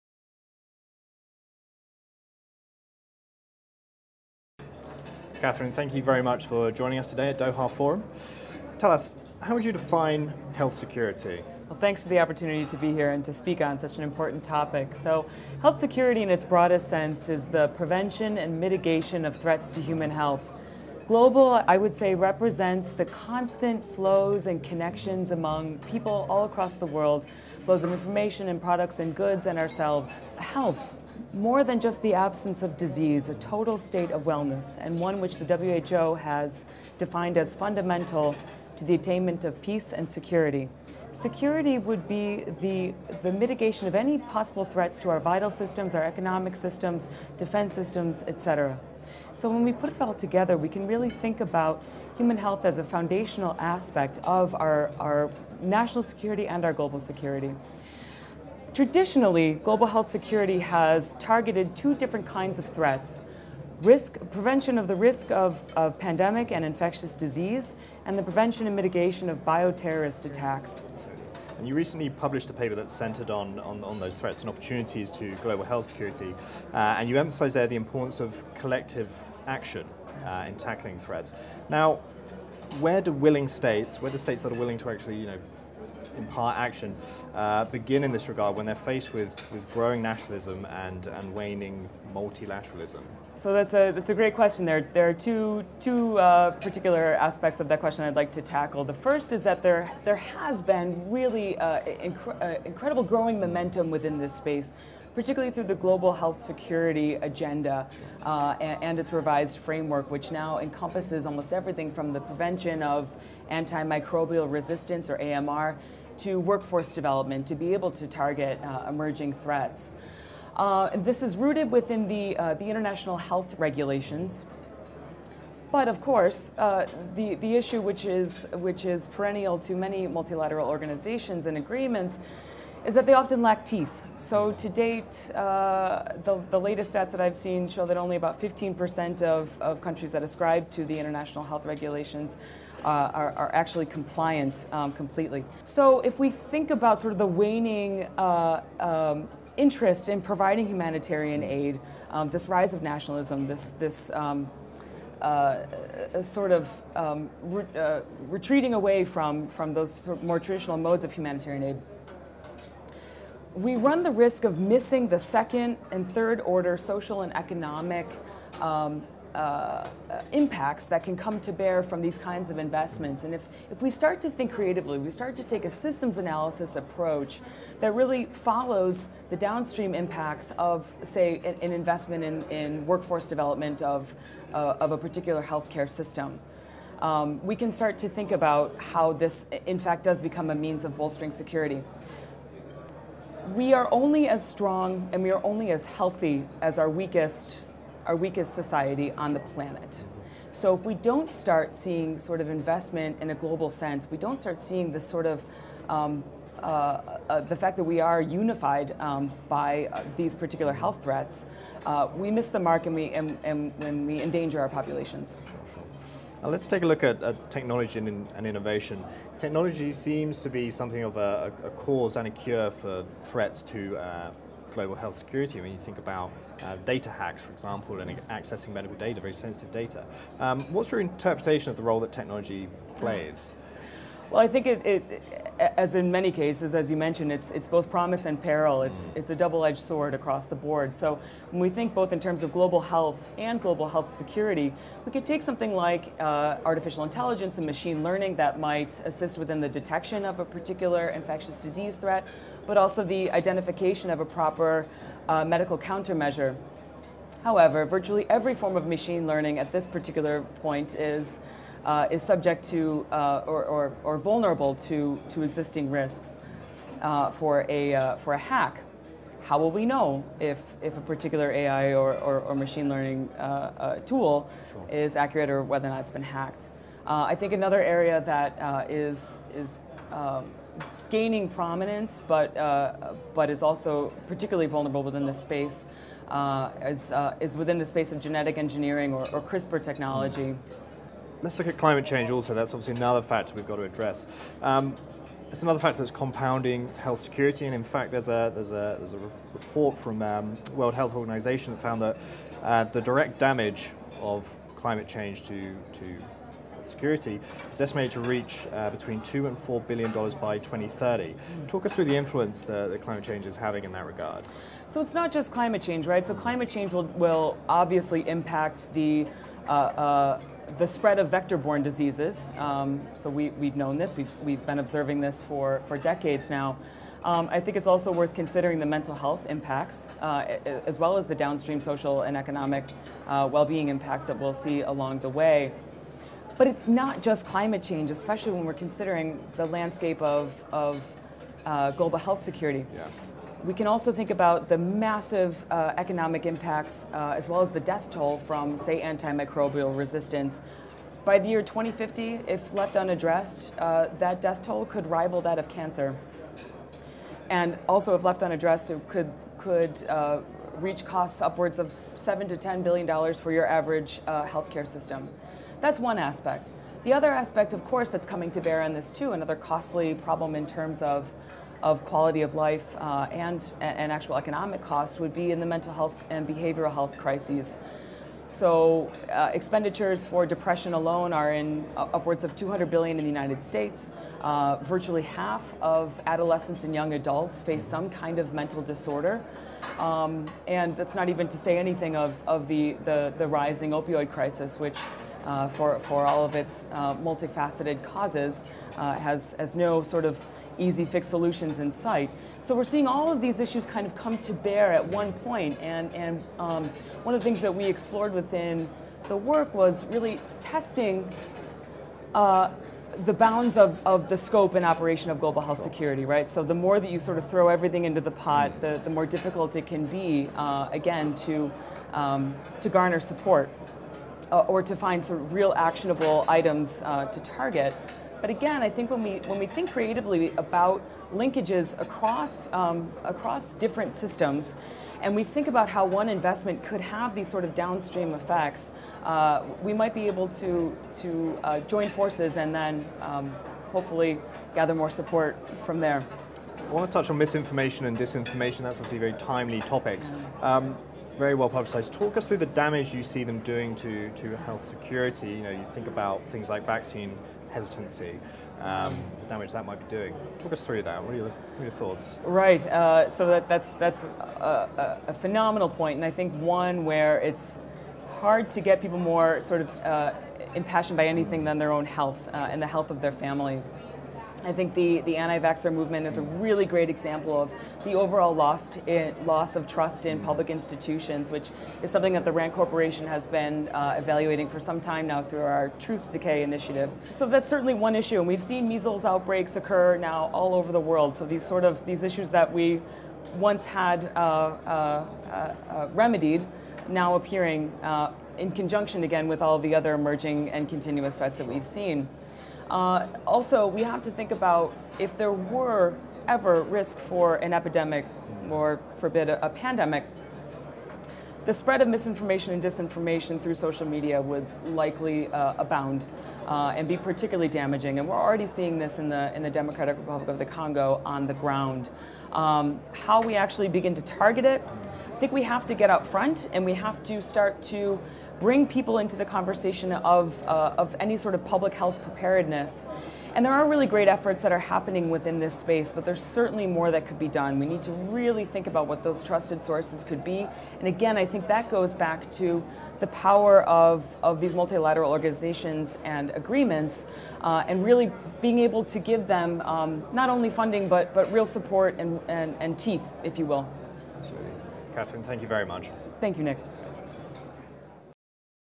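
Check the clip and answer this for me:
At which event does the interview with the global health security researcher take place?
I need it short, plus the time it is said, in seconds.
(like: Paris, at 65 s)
Doha Forum, at 7 s.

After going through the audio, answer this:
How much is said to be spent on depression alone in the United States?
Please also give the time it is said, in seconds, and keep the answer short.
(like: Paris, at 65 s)
200 billion, at 382 s.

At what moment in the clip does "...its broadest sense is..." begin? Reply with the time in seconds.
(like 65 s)
16 s.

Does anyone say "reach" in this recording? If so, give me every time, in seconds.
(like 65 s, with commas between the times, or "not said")
308 s, 360 s.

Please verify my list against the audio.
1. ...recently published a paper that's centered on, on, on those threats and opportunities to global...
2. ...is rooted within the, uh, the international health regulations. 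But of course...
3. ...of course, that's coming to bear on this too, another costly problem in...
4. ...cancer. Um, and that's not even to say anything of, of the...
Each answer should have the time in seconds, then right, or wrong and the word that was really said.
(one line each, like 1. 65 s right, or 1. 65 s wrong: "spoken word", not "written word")
1. 71 s right
2. 121 s right
3. 367 s right
4. 388 s wrong: "disorder", not "cancer".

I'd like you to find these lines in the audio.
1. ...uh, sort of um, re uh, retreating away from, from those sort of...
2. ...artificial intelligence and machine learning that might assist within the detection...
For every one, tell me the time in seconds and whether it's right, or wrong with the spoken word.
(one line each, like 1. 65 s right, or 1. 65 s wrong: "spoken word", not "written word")
1. 155 s right
2. 246 s right.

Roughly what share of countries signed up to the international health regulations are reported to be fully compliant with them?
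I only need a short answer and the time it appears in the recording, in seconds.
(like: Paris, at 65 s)
15%, at 138 s.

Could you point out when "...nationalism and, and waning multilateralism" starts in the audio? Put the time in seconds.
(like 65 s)
90 s.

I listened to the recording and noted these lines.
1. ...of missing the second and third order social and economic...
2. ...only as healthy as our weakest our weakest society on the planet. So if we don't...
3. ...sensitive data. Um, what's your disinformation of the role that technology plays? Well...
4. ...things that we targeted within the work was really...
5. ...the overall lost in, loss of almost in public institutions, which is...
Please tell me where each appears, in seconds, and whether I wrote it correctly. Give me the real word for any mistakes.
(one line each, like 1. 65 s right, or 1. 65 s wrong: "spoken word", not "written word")
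1. 164 s right
2. 195 s right
3. 229 s wrong: "interpretation", not "disinformation"
4. 407 s wrong: "explored", not "targeted"
5. 478 s wrong: "trust", not "almost".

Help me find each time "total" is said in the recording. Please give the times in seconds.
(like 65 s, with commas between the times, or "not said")
33 s.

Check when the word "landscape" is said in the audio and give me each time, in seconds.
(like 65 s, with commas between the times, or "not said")
339 s.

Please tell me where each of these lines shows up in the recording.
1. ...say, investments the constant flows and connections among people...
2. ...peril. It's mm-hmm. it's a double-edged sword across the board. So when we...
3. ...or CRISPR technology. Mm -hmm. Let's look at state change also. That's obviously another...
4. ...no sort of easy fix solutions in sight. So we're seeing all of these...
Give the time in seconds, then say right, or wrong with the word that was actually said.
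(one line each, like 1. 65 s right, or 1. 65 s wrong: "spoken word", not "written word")
1. 21 s wrong: "represents", not "investments"
2. 238 s right
3. 289 s wrong: "climate", not "state"
4. 399 s right.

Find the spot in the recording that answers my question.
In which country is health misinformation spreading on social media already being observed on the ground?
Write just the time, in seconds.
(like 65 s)
519 s.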